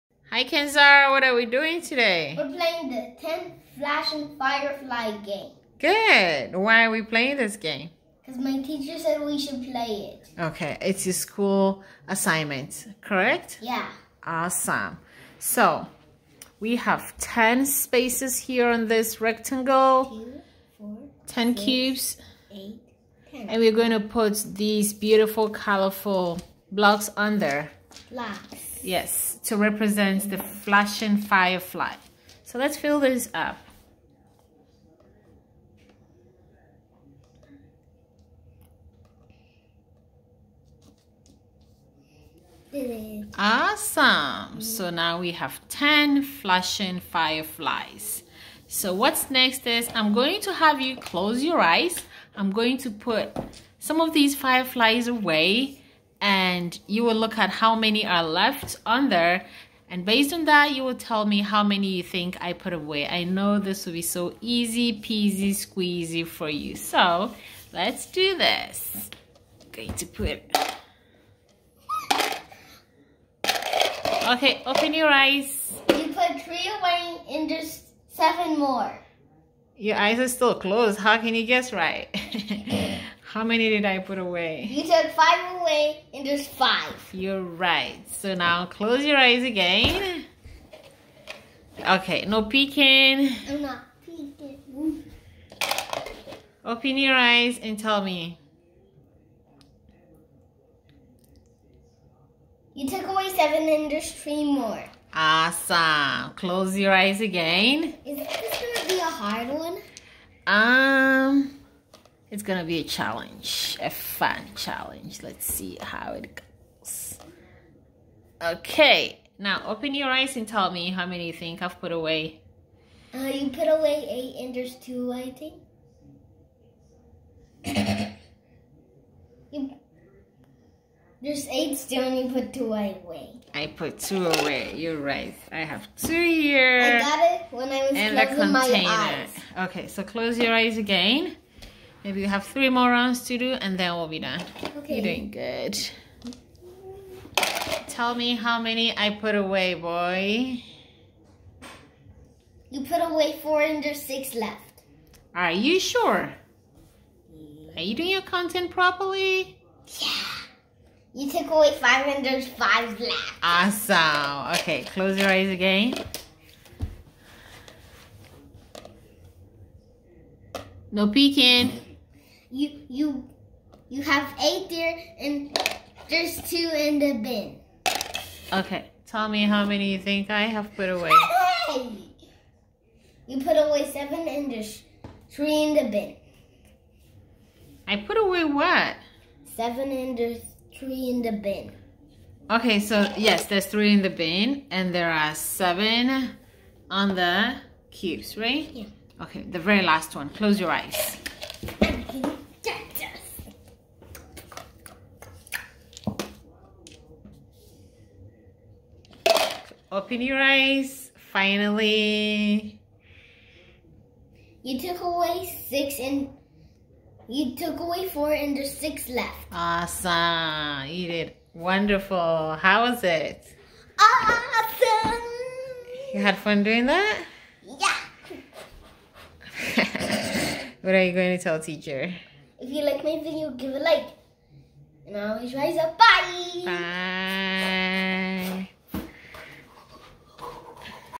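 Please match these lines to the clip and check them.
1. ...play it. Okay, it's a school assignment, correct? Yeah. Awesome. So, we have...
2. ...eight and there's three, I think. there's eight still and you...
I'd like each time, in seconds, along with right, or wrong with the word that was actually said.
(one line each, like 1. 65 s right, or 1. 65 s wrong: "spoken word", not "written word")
1. 9 s right
2. 124 s wrong: "two", not "three".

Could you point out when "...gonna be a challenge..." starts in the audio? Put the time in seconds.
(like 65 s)
112 s.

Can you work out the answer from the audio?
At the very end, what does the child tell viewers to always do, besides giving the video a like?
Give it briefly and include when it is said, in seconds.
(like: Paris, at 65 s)
rise up, at 235 s.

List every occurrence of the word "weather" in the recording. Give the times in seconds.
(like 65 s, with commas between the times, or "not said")
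not said.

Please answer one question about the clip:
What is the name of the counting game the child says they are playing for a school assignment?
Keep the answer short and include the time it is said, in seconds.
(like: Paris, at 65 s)
10 flashing Firefly game, at 3 s.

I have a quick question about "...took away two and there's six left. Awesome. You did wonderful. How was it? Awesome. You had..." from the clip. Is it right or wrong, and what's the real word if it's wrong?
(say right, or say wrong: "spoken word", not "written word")
wrong: "four", not "two".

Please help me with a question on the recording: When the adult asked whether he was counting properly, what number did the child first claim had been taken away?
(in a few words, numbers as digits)
4.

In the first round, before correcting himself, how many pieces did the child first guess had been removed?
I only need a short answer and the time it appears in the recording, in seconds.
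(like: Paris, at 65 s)
3, at 75 s.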